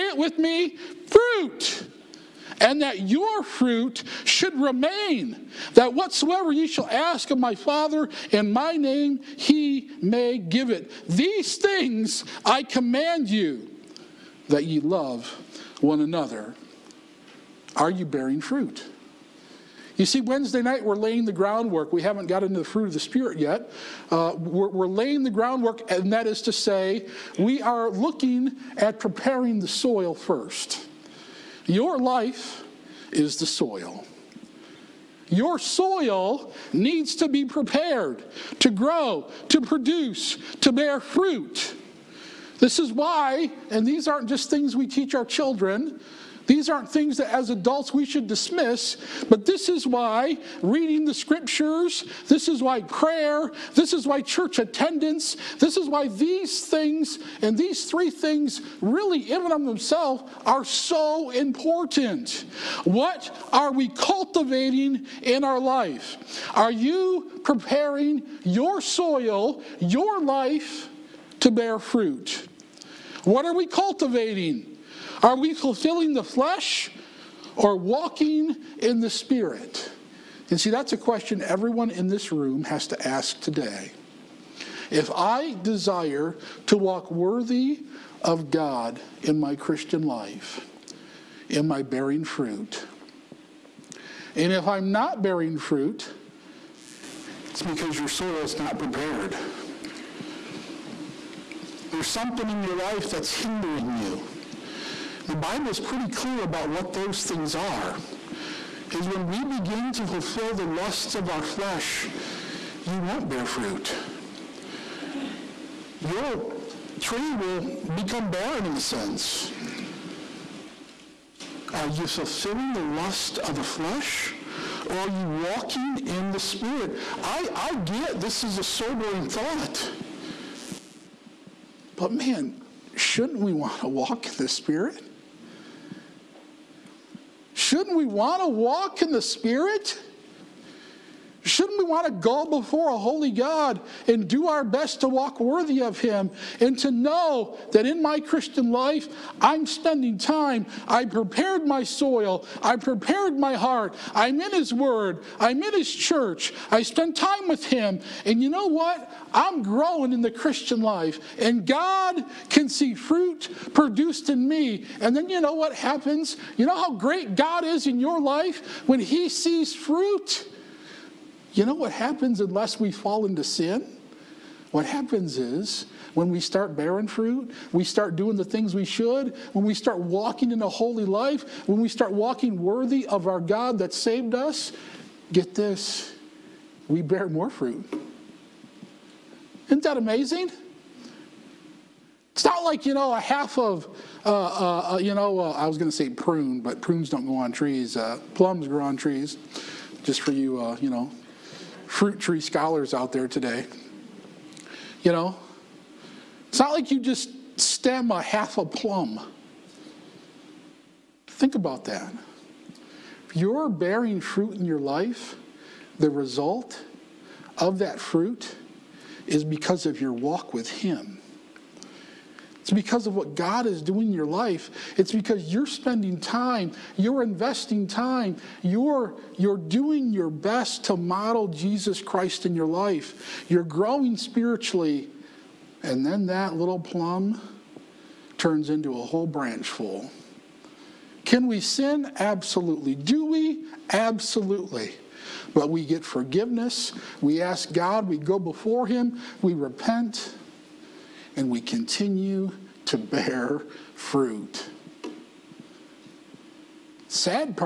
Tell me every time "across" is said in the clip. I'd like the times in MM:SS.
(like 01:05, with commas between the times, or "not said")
not said.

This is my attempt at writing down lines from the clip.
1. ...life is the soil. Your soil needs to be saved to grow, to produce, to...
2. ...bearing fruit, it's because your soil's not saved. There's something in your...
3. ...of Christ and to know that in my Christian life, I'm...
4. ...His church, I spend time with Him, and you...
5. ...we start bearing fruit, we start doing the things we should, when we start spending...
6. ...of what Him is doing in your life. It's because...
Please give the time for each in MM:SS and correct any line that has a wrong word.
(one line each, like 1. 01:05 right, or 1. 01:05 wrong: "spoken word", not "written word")
1. 00:31 wrong: "prepared", not "saved"
2. 01:35 wrong: "prepared", not "saved"
3. 02:25 wrong: "Him", not "Christ"
4. 02:35 right
5. 02:56 wrong: "walking", not "spending"
6. 03:43 wrong: "God", not "Him".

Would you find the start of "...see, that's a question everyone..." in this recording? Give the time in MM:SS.
01:20.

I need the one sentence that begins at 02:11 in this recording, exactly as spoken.
But man, shouldn't we want to walk in the Spirit?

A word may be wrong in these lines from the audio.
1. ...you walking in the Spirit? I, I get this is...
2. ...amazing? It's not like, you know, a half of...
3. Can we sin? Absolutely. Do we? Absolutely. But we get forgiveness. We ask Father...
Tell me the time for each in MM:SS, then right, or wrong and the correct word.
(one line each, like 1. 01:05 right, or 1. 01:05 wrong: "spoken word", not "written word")
1. 02:05 right
2. 03:09 right
3. 04:01 wrong: "God", not "Father".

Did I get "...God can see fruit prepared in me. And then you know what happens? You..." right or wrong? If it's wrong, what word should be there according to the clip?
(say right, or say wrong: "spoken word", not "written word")
wrong: "produced", not "prepared".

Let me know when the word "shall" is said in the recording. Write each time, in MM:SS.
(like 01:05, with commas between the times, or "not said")
00:06.